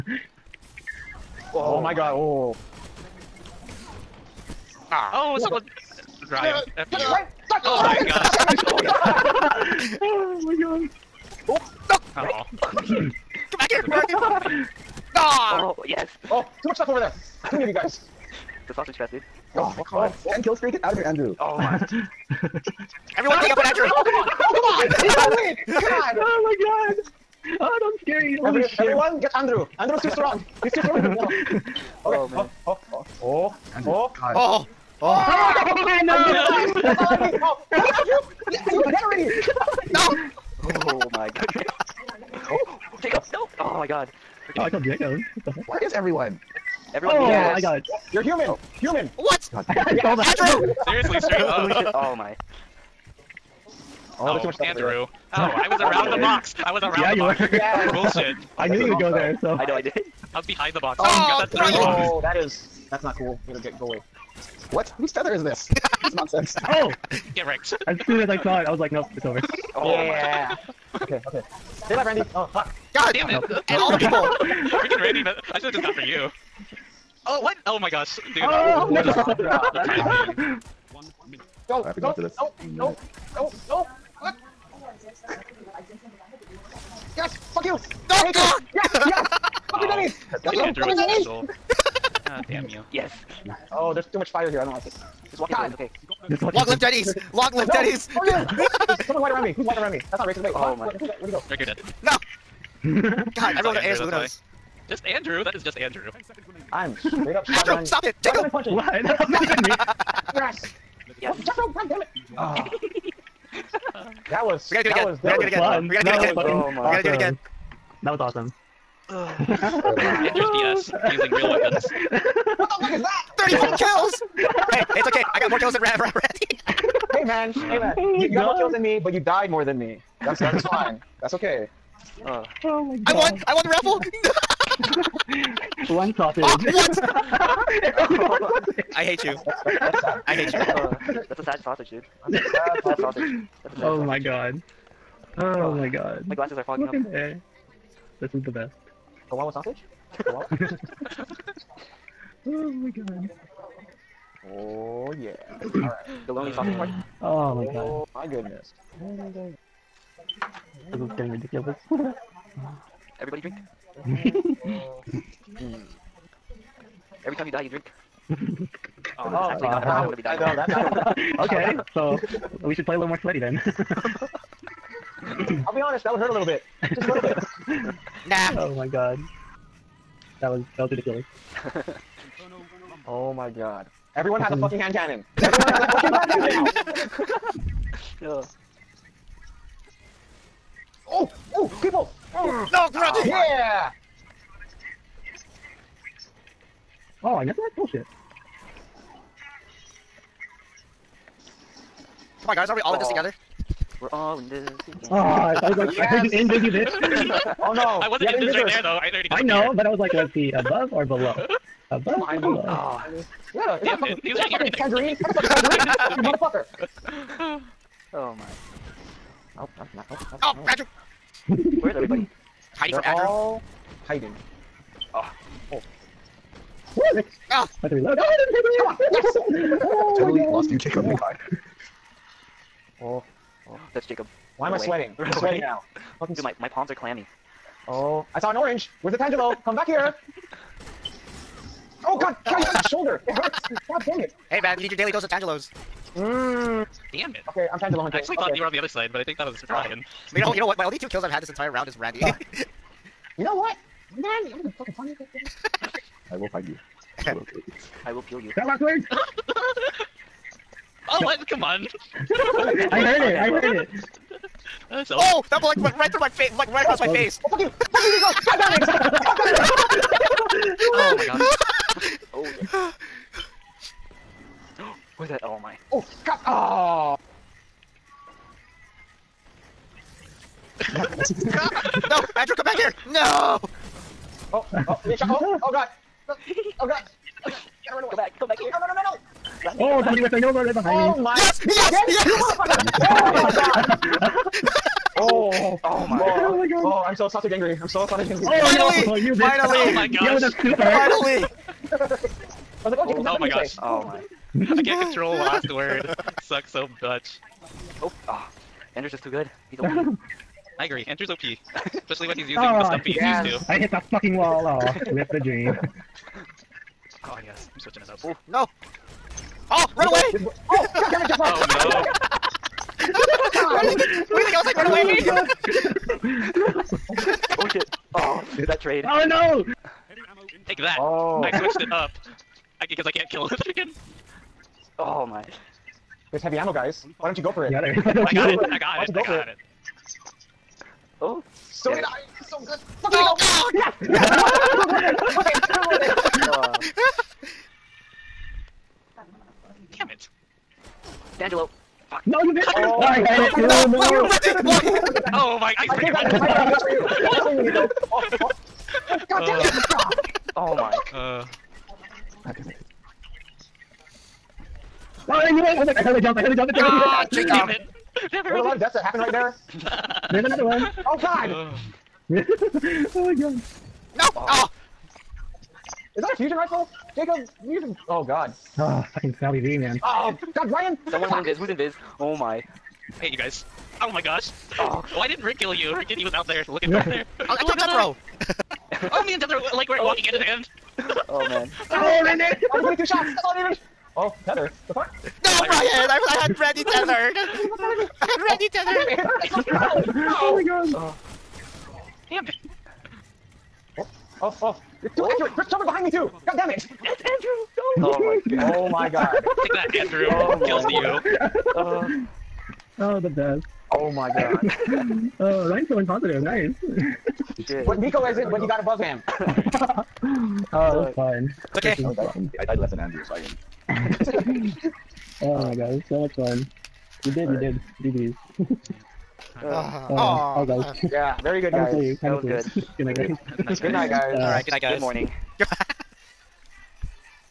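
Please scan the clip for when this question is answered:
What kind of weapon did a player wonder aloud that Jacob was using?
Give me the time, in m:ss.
6:16.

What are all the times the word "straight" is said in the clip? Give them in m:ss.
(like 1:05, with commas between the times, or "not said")
0:51, 1:47.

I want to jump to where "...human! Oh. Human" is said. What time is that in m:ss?
0:48.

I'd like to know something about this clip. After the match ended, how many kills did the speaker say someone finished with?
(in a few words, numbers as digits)
34.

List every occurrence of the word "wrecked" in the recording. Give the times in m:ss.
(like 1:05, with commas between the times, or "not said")
1:07, 5:54.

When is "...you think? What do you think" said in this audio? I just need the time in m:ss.
5:23.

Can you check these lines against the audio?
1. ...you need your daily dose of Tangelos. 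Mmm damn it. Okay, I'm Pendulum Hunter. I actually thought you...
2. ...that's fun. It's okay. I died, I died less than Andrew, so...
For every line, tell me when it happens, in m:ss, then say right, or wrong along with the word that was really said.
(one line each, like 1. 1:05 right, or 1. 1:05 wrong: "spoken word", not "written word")
1. 4:04 right
2. 7:01 right.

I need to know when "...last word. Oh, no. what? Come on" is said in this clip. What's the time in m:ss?
4:18.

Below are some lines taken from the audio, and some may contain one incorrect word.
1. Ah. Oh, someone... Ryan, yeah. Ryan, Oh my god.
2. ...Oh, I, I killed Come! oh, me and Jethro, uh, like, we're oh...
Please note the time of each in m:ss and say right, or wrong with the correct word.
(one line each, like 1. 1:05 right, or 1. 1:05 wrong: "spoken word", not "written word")
1. 0:04 right
2. 6:27 wrong: "Jethro", not "Come".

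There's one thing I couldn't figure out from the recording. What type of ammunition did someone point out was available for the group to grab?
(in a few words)
Heavy ammo.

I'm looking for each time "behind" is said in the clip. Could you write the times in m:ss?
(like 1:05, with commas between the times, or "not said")
1:00, 4:50, 6:45.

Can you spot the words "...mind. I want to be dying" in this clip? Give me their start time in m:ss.
2:49.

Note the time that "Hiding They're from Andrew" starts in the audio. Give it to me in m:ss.
3:42.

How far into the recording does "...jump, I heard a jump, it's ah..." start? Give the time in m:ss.
6:06.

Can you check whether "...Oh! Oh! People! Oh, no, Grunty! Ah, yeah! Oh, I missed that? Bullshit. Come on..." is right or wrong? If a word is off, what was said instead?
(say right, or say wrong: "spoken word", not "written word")
right.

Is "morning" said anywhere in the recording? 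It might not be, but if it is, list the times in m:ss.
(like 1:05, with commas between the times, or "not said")
7:15.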